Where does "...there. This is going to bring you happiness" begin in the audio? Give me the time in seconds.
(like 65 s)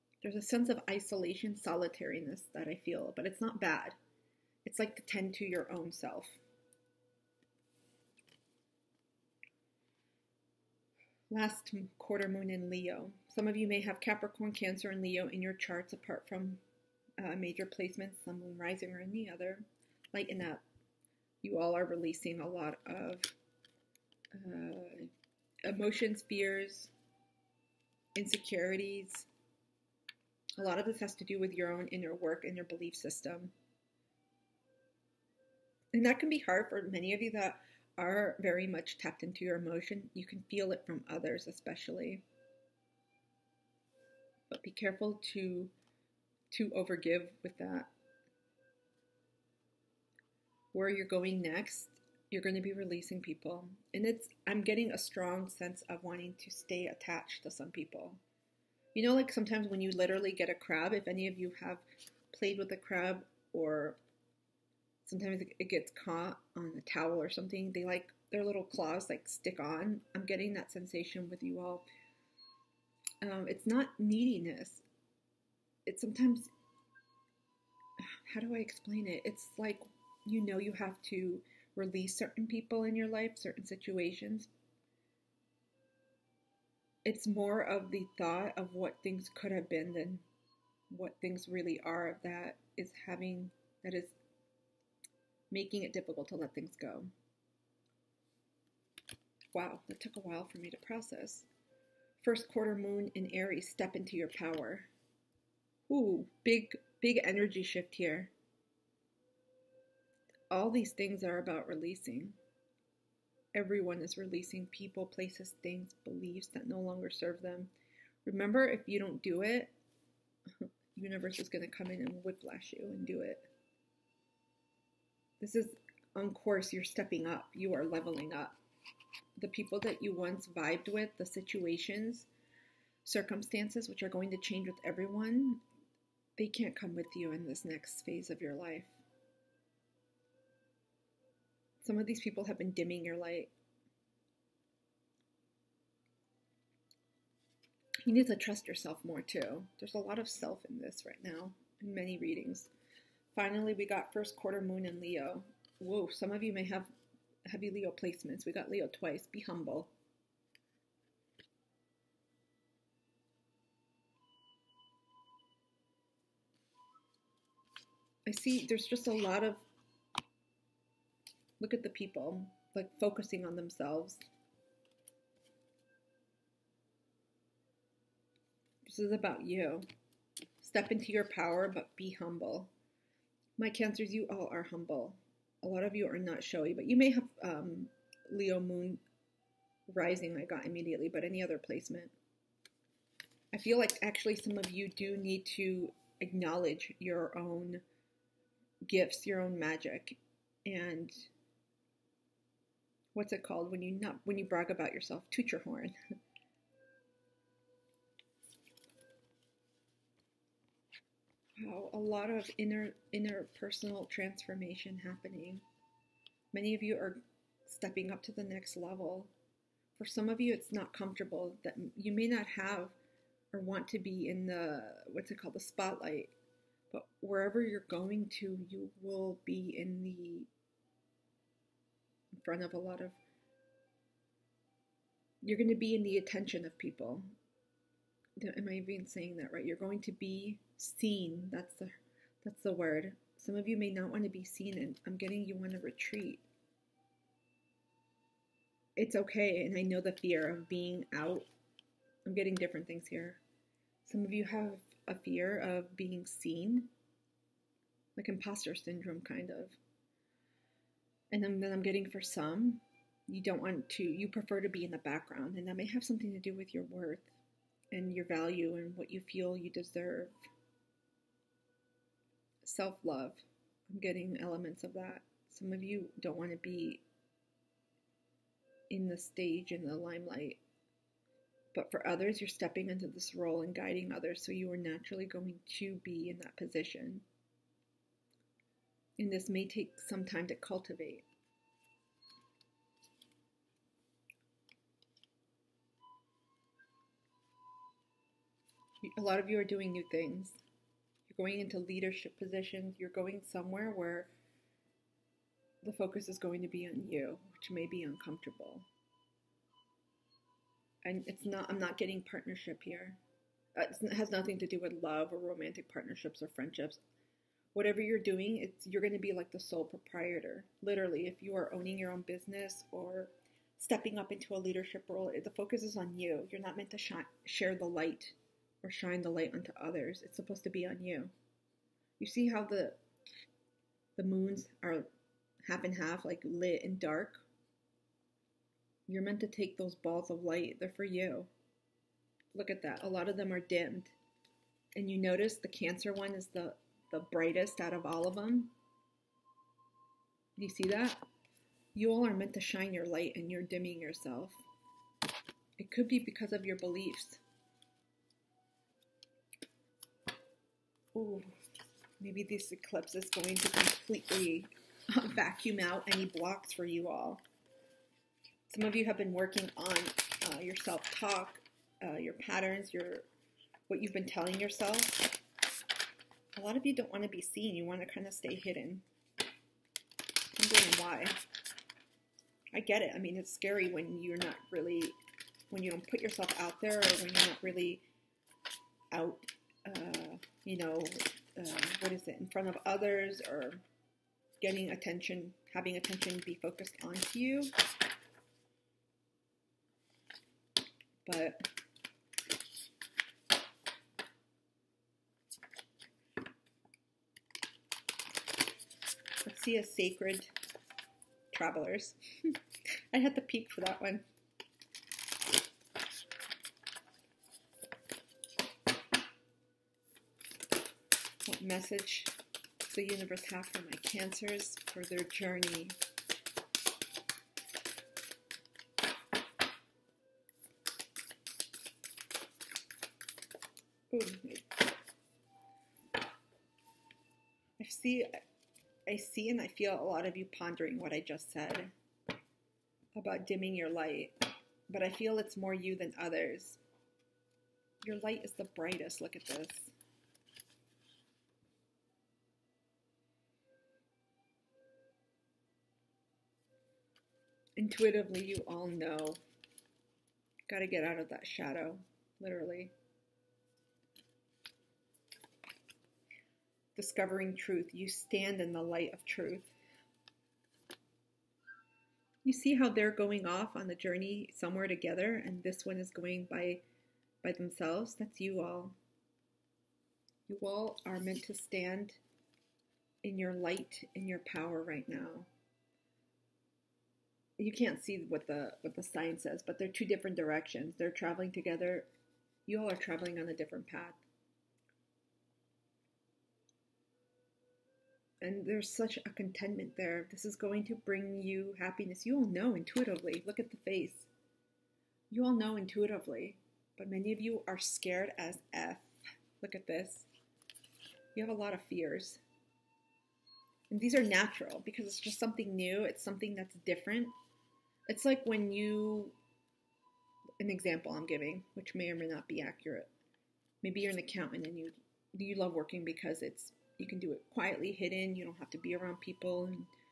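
499 s.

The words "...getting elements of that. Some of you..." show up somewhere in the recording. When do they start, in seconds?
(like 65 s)
273 s.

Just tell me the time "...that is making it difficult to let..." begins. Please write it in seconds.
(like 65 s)
93 s.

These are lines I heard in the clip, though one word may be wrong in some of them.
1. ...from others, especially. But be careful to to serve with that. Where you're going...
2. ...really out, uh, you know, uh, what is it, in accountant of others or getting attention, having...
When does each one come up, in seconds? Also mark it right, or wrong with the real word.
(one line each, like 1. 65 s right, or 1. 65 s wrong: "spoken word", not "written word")
1. 40 s wrong: "overgive", not "serve"
2. 387 s wrong: "front", not "accountant".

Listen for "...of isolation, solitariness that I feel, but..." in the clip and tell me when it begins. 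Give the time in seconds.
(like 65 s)
0 s.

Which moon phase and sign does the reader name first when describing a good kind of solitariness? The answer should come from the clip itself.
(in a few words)
Last quarter moon in Leo.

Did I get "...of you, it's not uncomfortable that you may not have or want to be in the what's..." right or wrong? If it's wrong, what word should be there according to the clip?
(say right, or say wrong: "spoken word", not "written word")
wrong: "comfortable", not "uncomfortable".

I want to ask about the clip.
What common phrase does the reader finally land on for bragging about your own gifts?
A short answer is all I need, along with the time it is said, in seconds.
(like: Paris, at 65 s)
Toot your horn, at 205 s.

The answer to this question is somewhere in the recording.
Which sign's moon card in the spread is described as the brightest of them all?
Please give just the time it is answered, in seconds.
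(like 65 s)
345 s.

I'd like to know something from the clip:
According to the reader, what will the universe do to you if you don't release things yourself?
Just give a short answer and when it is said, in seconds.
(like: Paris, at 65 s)
Whiplash you, at 122 s.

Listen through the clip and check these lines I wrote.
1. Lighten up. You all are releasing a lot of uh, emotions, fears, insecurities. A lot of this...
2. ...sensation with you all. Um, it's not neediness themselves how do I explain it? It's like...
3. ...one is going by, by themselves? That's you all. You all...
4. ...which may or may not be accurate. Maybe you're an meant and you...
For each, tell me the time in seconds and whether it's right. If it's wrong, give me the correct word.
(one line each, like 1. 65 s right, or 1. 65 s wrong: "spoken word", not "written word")
1. 20 s right
2. 70 s wrong: "sometimes", not "themselves"
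3. 475 s right
4. 521 s wrong: "accountant", not "meant".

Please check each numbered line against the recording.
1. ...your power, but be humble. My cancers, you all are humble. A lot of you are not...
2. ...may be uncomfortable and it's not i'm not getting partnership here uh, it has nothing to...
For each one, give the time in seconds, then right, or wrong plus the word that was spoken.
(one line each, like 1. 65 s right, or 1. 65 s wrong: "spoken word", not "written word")
1. 181 s right
2. 307 s right.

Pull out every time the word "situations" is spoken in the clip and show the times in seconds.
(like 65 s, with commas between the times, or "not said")
83 s, 131 s.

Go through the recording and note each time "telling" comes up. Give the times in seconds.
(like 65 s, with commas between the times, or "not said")
374 s.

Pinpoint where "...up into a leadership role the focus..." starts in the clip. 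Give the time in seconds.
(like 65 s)
324 s.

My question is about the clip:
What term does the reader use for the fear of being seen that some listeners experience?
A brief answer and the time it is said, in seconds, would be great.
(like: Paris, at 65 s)
Imposter syndrome, at 258 s.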